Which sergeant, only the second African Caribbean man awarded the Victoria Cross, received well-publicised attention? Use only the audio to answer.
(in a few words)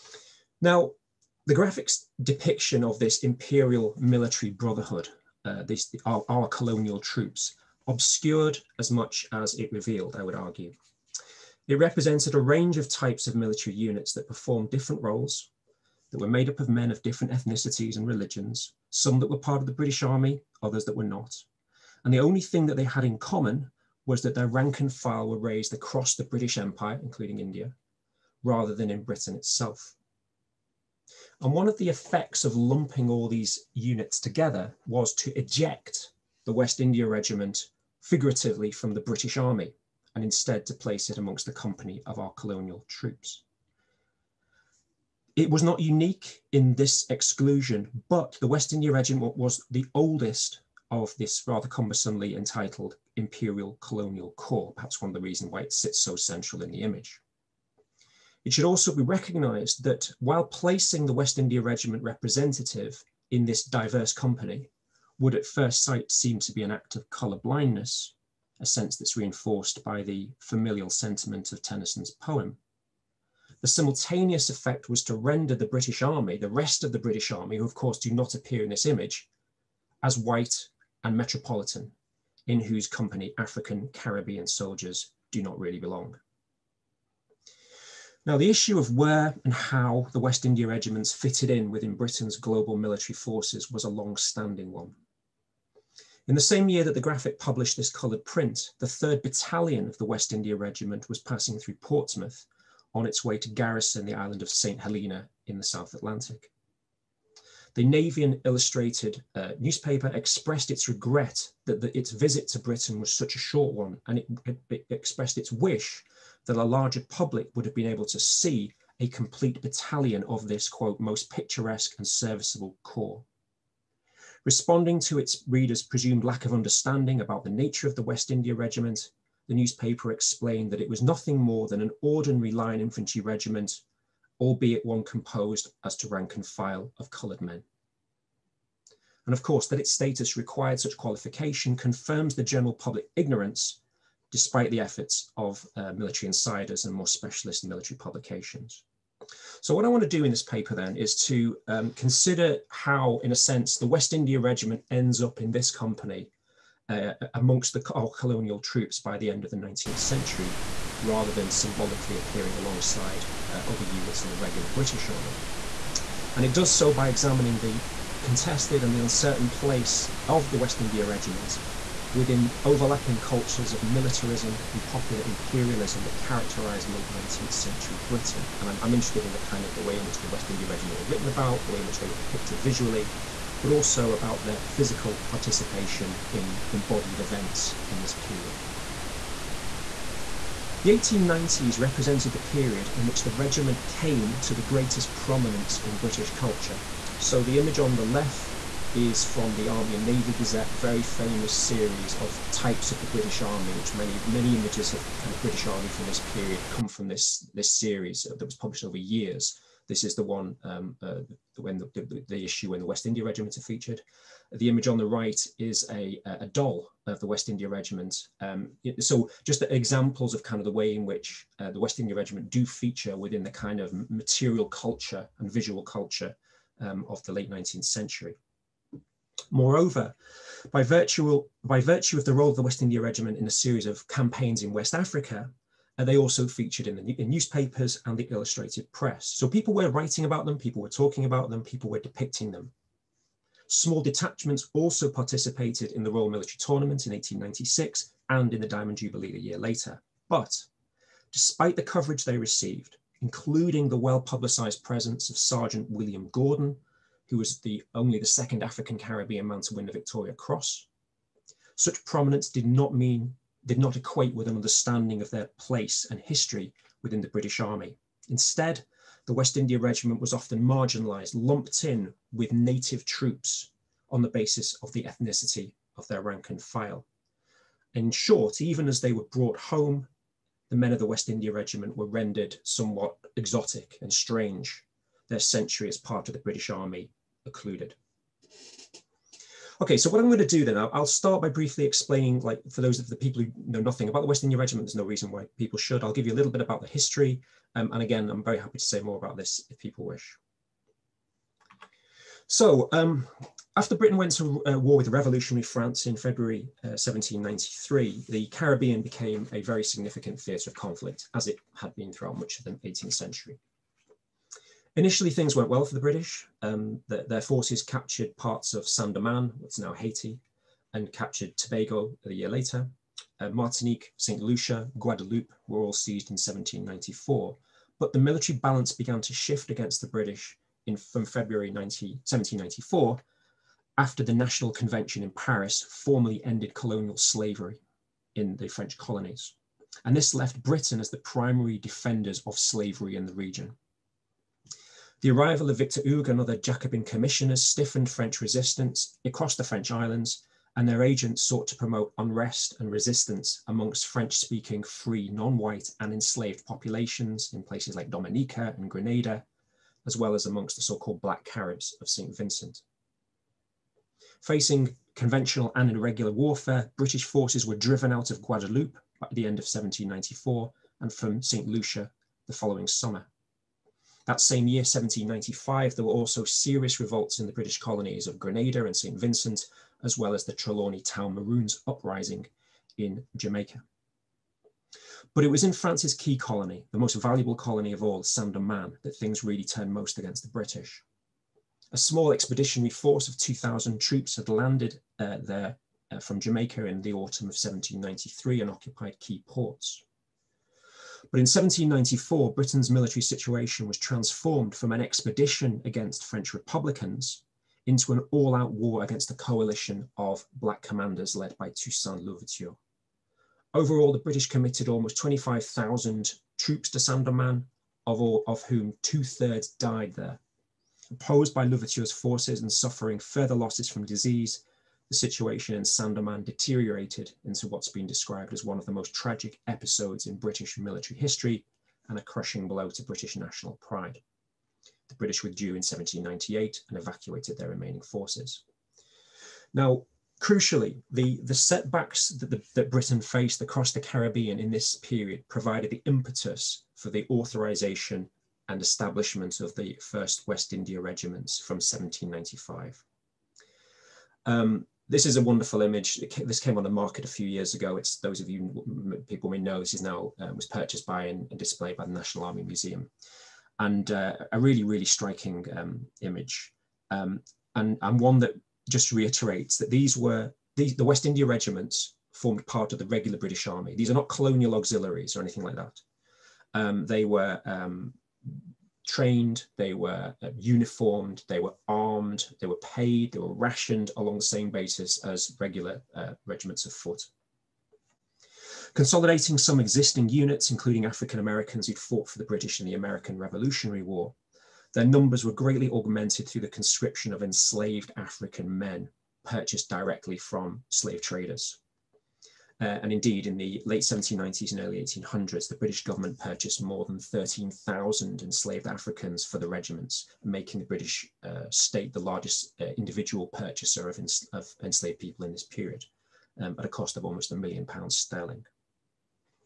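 William Gordon.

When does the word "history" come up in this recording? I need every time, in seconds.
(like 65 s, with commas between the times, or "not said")
266 s, 296 s, 431 s.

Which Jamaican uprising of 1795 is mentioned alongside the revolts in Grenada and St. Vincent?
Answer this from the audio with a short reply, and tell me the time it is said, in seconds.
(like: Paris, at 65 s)
Trelawny Town Maroons, at 380 s.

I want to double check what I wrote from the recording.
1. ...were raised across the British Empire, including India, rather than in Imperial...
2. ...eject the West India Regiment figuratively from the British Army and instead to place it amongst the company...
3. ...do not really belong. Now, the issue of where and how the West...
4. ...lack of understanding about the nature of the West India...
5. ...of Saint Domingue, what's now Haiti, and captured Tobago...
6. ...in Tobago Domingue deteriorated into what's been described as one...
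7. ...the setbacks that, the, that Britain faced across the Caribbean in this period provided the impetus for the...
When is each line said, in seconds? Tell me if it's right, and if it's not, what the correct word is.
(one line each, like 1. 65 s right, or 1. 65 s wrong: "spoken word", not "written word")
1. 25 s wrong: "Britain", not "Imperial"
2. 35 s right
3. 85 s right
4. 126 s right
5. 318 s right
6. 425 s wrong: "Saint", not "Tobago"
7. 441 s right.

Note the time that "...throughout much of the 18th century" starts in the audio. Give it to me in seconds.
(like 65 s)
312 s.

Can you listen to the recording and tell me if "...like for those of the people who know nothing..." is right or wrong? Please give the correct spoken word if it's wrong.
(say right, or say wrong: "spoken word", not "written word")
right.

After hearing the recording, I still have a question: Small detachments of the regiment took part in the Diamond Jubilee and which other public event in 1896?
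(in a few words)
Royal Military Tournament.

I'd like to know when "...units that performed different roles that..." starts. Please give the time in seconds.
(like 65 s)
13 s.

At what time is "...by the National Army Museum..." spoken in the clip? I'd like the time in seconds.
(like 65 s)
461 s.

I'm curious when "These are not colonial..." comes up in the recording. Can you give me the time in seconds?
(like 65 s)
473 s.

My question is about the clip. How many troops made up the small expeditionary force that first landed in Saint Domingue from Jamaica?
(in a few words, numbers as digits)
2,000.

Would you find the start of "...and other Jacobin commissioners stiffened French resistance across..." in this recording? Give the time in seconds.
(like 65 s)
346 s.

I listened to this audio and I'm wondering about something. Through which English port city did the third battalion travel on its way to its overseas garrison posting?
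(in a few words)
Portsmouth.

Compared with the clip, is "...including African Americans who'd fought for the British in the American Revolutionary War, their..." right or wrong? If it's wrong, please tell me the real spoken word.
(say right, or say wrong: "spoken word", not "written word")
right.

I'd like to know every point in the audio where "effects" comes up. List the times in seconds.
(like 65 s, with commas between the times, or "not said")
31 s, 74 s.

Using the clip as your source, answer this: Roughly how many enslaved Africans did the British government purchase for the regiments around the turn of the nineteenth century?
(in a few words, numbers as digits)
13,000.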